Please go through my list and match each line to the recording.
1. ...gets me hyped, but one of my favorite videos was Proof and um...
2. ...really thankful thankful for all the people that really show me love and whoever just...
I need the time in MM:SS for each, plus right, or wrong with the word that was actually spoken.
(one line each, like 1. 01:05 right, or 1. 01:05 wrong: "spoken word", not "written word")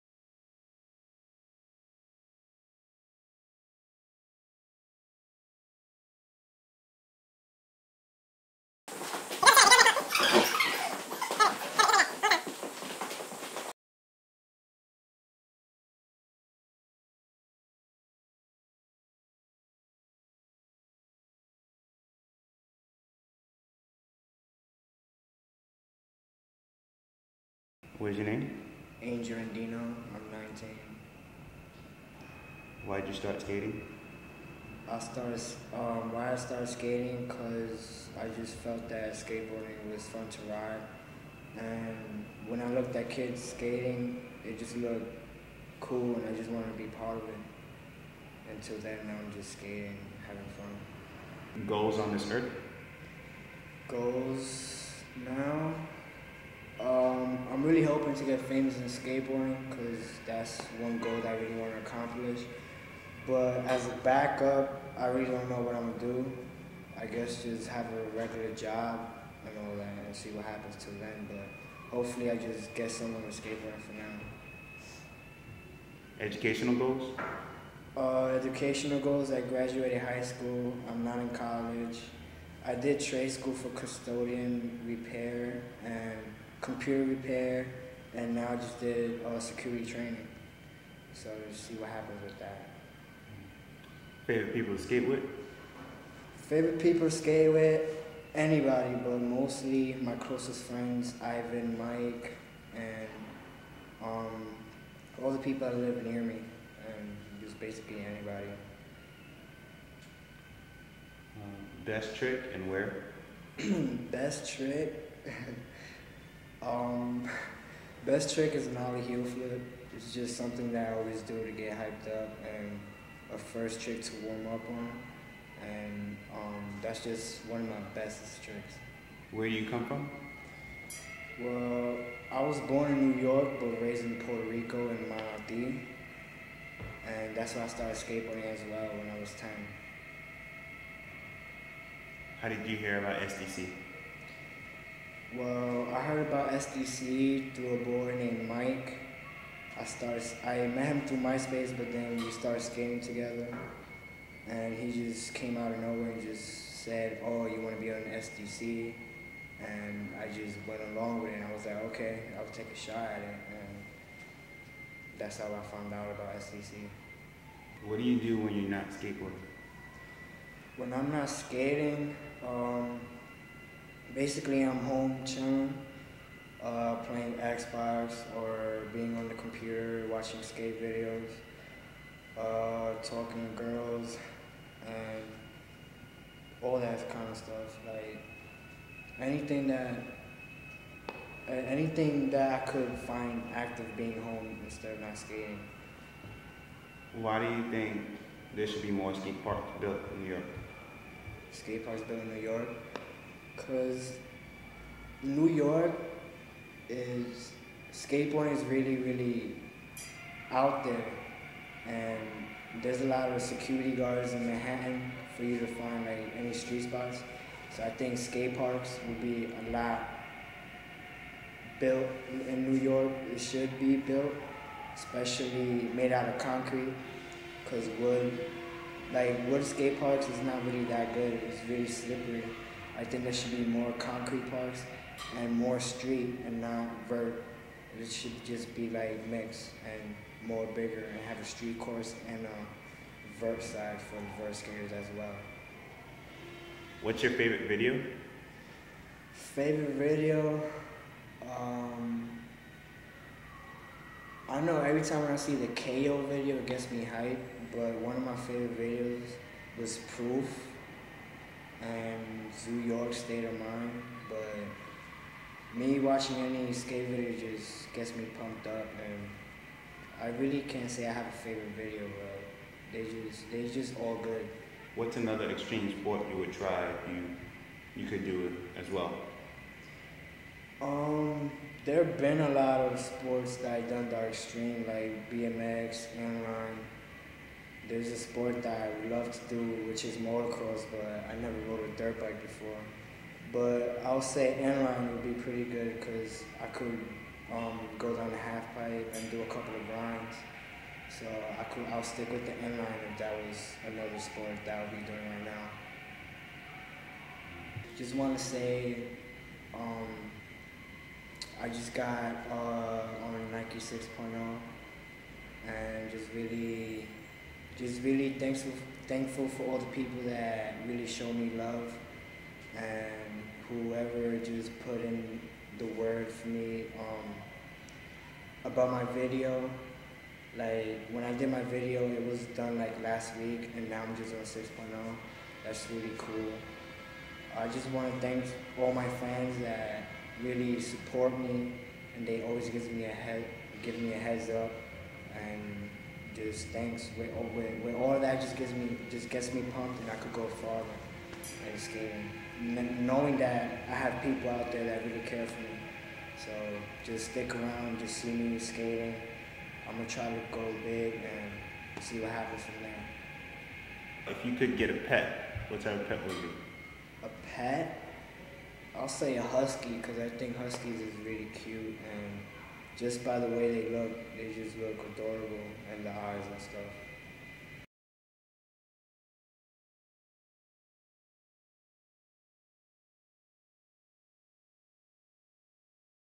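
1. 04:16 right
2. 05:18 right.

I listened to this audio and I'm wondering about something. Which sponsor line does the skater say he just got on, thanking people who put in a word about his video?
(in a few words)
Nike 6.0.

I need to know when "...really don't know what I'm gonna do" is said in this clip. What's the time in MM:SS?
01:05.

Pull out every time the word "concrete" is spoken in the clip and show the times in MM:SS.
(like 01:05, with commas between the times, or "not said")
03:46, 03:53.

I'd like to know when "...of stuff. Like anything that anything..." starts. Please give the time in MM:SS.
03:07.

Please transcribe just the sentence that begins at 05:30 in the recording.
Like when I did my video, it was done like last week, and now I'm just on 6.0.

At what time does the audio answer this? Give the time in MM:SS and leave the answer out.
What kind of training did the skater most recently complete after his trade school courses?
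01:29.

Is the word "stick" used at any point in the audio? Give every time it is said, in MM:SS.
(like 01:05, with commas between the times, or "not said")
05:02, 05:57.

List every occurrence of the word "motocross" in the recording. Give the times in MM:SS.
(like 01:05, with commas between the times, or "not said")
04:50.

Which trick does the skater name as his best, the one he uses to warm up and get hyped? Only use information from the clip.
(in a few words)
Ollie heel flip.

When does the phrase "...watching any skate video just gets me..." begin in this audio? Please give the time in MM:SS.
04:25.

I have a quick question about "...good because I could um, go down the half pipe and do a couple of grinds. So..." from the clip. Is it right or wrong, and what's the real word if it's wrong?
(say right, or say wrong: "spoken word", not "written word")
right.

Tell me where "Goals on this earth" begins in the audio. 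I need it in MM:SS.
00:51.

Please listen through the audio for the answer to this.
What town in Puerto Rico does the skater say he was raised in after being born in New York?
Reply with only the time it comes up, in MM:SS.
02:15.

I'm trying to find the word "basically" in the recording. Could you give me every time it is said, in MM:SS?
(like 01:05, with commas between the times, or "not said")
01:47, 02:54.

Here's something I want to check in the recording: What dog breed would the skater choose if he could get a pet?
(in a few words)
Husky.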